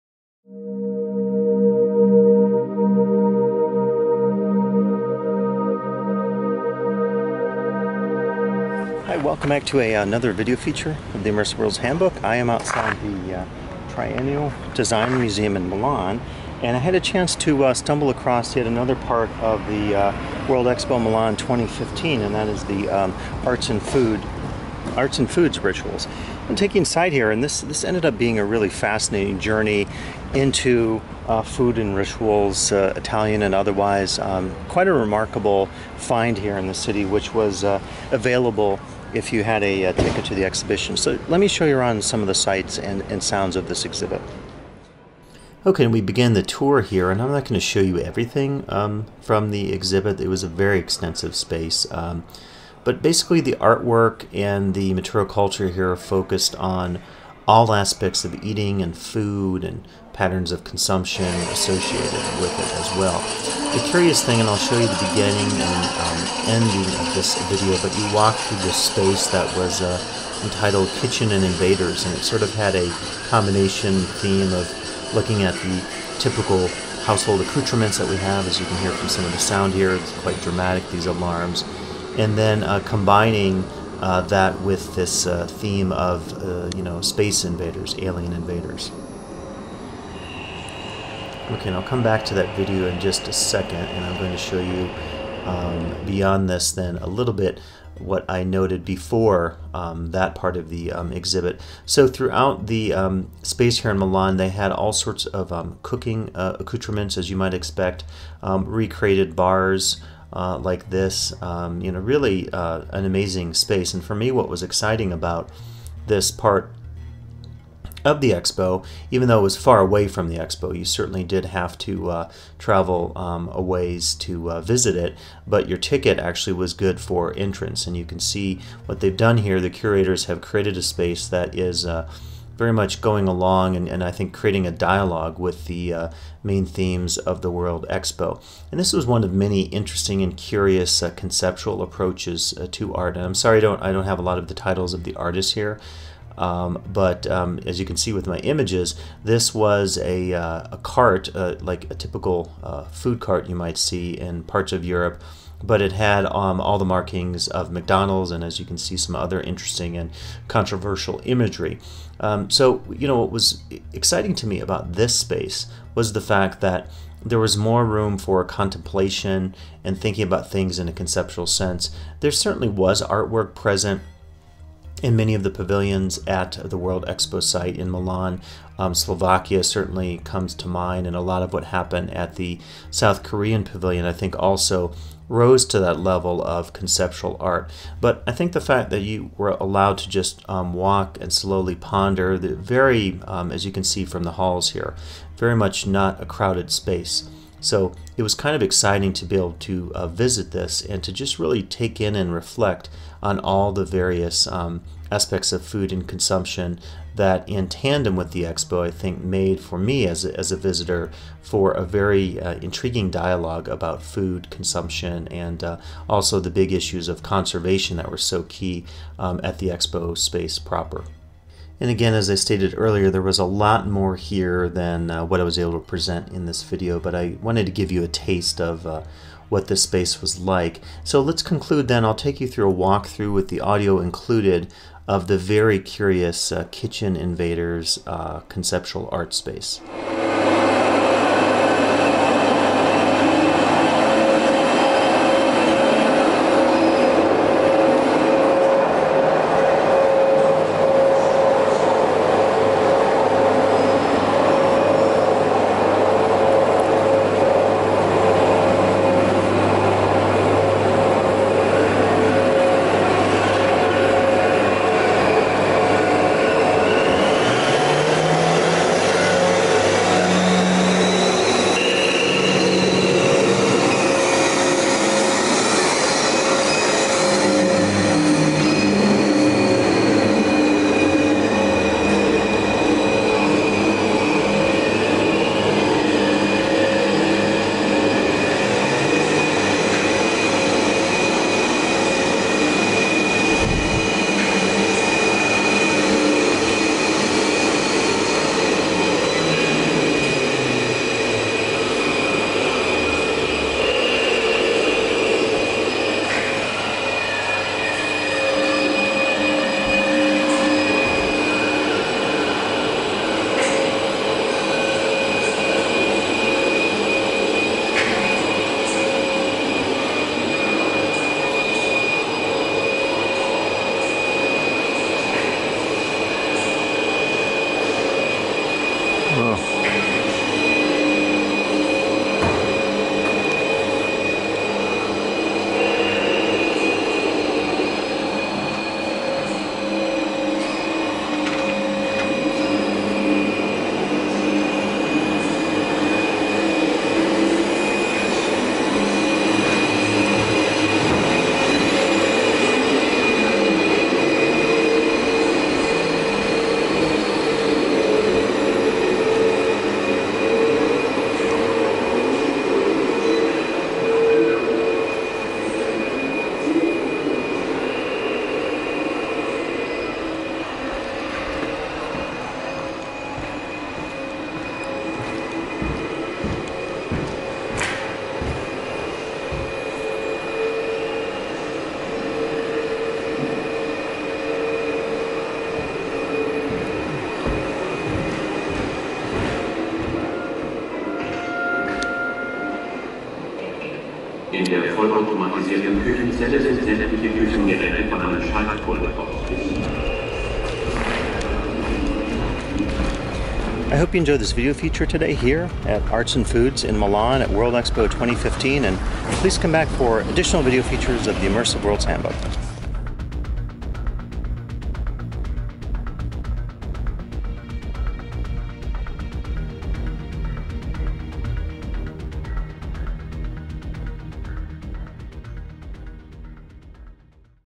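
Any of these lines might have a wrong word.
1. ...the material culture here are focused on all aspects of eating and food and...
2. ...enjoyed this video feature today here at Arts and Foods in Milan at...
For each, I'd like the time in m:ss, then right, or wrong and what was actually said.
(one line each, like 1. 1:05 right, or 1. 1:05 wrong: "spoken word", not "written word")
1. 0:54 right
2. 6:44 right.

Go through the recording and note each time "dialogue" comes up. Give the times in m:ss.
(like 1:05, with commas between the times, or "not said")
2:14, 3:33.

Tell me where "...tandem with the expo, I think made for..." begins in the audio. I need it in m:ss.
3:27.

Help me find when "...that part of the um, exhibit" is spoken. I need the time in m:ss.
1:40.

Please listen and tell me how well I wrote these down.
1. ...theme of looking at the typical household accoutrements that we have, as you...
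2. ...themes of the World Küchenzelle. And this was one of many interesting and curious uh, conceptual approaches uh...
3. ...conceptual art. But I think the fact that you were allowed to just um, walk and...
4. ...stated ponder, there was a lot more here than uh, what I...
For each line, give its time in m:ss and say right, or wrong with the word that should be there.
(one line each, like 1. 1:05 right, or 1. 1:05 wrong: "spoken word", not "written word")
1. 1:14 right
2. 2:16 wrong: "Expo", not "Küchenzelle"
3. 3:06 right
4. 3:42 wrong: "earlier", not "ponder".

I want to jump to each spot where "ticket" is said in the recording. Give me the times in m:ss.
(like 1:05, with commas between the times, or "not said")
0:39, 2:05.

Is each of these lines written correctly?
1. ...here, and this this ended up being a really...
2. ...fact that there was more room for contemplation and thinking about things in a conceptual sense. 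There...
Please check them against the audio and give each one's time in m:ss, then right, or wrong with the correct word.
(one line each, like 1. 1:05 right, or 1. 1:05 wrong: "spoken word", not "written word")
1. 0:27 right
2. 2:46 right.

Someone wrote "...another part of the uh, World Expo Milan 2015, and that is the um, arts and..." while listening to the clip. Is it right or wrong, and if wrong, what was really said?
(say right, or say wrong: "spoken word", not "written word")
right.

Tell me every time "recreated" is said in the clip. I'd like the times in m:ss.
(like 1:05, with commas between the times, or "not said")
1:48.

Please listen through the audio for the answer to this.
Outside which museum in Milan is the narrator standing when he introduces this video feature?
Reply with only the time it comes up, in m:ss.
0:13.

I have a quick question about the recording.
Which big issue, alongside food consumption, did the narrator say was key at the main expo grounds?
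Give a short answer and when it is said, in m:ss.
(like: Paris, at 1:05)
conservation, at 3:37.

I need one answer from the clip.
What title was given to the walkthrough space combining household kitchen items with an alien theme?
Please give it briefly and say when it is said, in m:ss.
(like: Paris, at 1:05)
Kitchen and Invaders, at 1:11.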